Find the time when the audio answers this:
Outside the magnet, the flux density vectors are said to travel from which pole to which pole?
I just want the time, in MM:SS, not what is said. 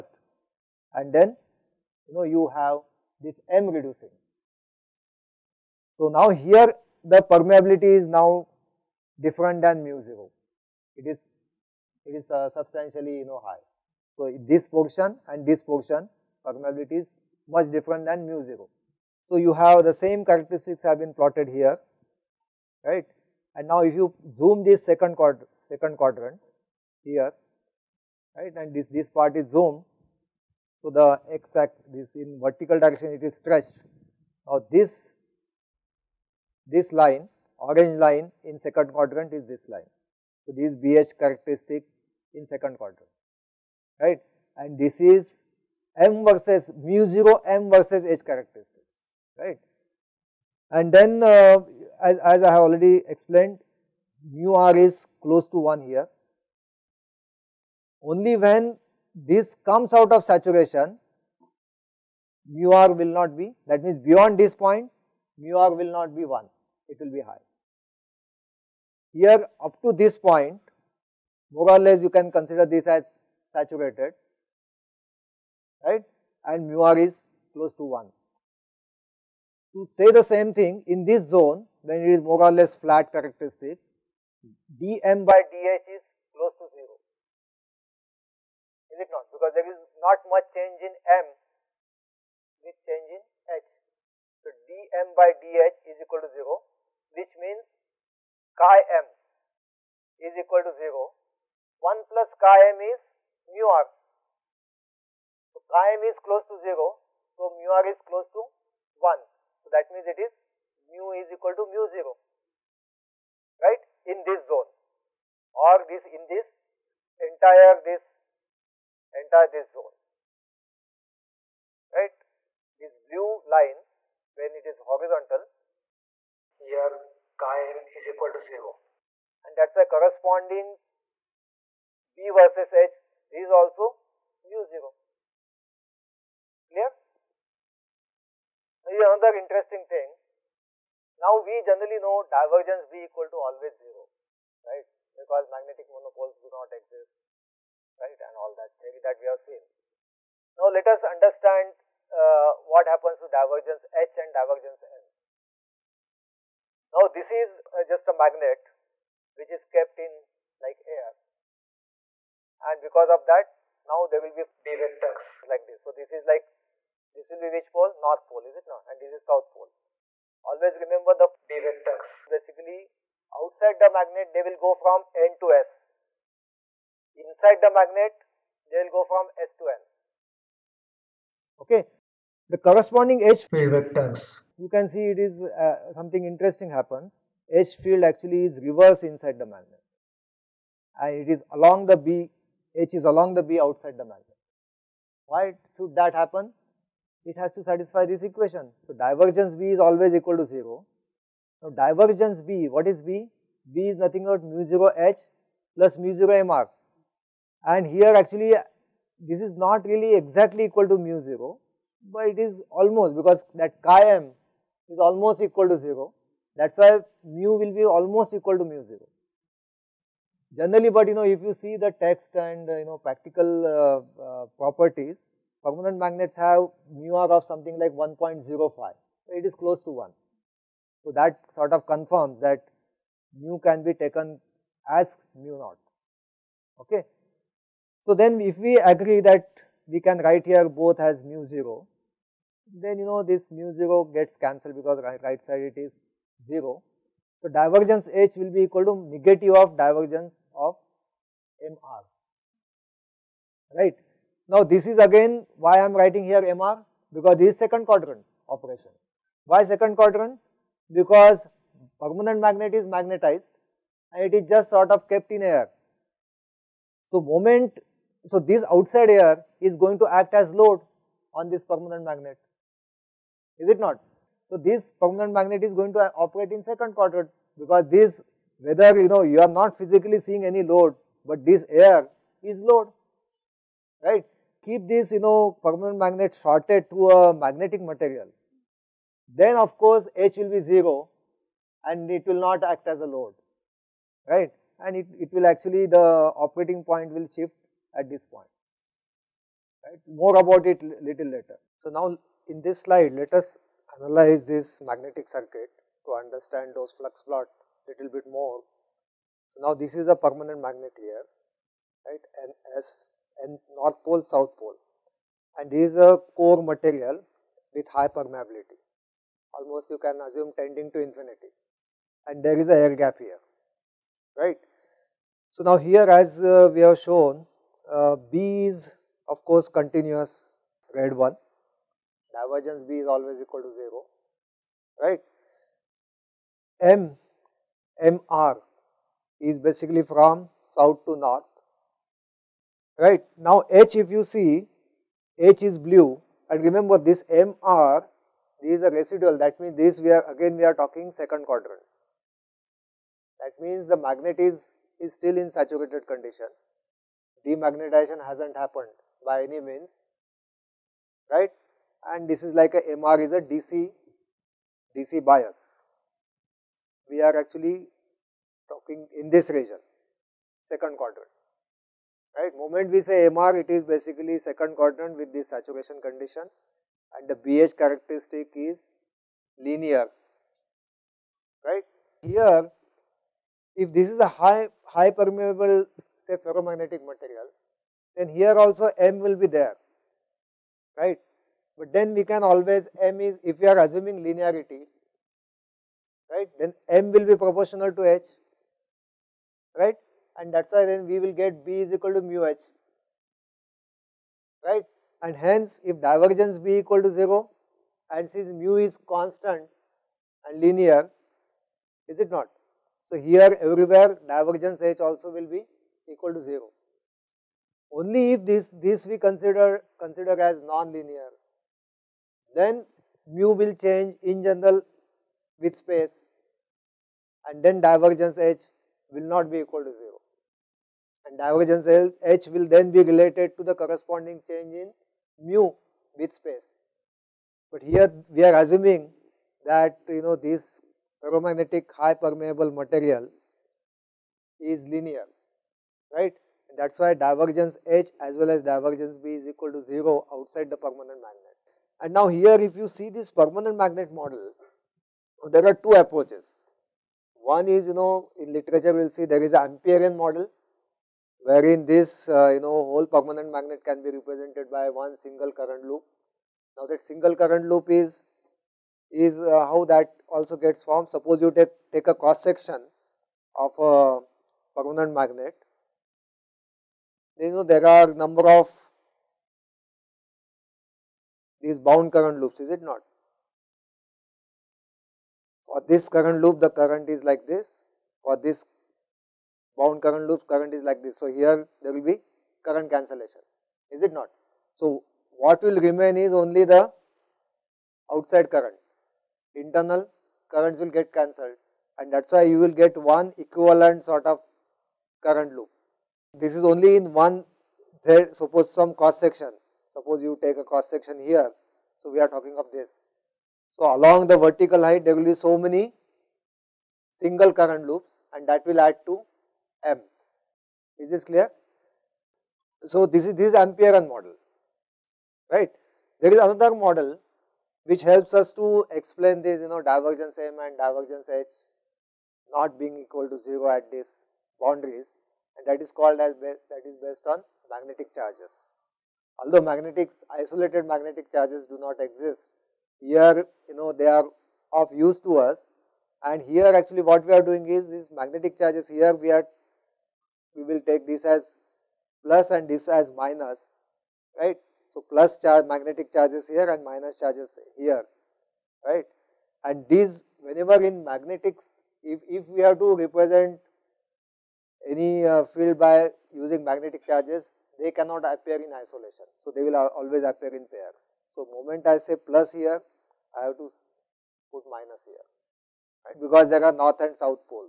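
02:55.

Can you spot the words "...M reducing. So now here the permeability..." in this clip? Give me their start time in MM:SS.
00:03.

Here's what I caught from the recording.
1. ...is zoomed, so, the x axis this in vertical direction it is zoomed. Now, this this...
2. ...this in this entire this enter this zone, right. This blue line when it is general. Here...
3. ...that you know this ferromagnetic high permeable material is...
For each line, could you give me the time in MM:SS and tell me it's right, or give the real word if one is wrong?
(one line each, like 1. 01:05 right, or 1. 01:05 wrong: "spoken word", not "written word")
1. 00:29 wrong: "stretched", not "zoomed"
2. 01:55 wrong: "horizontal", not "general"
3. 07:19 right.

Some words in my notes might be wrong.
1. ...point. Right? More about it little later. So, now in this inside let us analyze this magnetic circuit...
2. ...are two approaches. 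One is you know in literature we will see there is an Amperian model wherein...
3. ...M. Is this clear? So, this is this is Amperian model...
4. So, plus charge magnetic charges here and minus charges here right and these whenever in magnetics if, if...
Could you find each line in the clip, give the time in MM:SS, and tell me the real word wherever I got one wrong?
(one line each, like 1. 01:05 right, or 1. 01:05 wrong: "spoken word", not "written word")
1. 04:58 wrong: "slide", not "inside"
2. 07:35 right
3. 08:39 right
4. 09:14 right.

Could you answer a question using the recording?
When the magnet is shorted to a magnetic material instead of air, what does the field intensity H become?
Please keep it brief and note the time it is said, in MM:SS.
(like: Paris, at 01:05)
0, at 04:50.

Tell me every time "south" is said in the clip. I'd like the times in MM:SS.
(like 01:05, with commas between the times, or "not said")
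02:49, 05:14, 05:40.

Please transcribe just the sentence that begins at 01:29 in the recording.
Because there is not much change in m with change in h.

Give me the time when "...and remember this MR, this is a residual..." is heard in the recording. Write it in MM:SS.
05:46.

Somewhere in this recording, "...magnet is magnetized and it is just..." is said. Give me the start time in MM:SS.
04:22.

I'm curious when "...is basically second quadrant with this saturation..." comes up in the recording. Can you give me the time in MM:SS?
06:13.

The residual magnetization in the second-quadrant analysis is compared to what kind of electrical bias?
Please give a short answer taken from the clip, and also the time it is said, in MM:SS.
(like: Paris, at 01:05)
DC bias, at 06:03.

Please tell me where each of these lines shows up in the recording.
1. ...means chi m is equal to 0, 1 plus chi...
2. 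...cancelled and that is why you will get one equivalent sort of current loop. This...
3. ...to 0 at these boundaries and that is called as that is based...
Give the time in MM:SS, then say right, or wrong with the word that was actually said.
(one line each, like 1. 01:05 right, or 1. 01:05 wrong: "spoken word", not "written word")
1. 01:37 right
2. 08:21 right
3. 08:53 right.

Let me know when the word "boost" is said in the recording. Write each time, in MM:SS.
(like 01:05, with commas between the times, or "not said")
not said.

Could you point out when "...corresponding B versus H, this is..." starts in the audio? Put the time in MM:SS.
02:09.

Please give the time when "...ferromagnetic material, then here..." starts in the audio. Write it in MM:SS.
06:26.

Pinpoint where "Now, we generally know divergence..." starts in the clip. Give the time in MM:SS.
02:21.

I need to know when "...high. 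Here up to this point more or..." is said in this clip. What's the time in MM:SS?
01:07.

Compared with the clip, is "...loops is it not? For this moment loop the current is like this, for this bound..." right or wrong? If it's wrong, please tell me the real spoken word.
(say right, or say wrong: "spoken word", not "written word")
wrong: "current", not "moment".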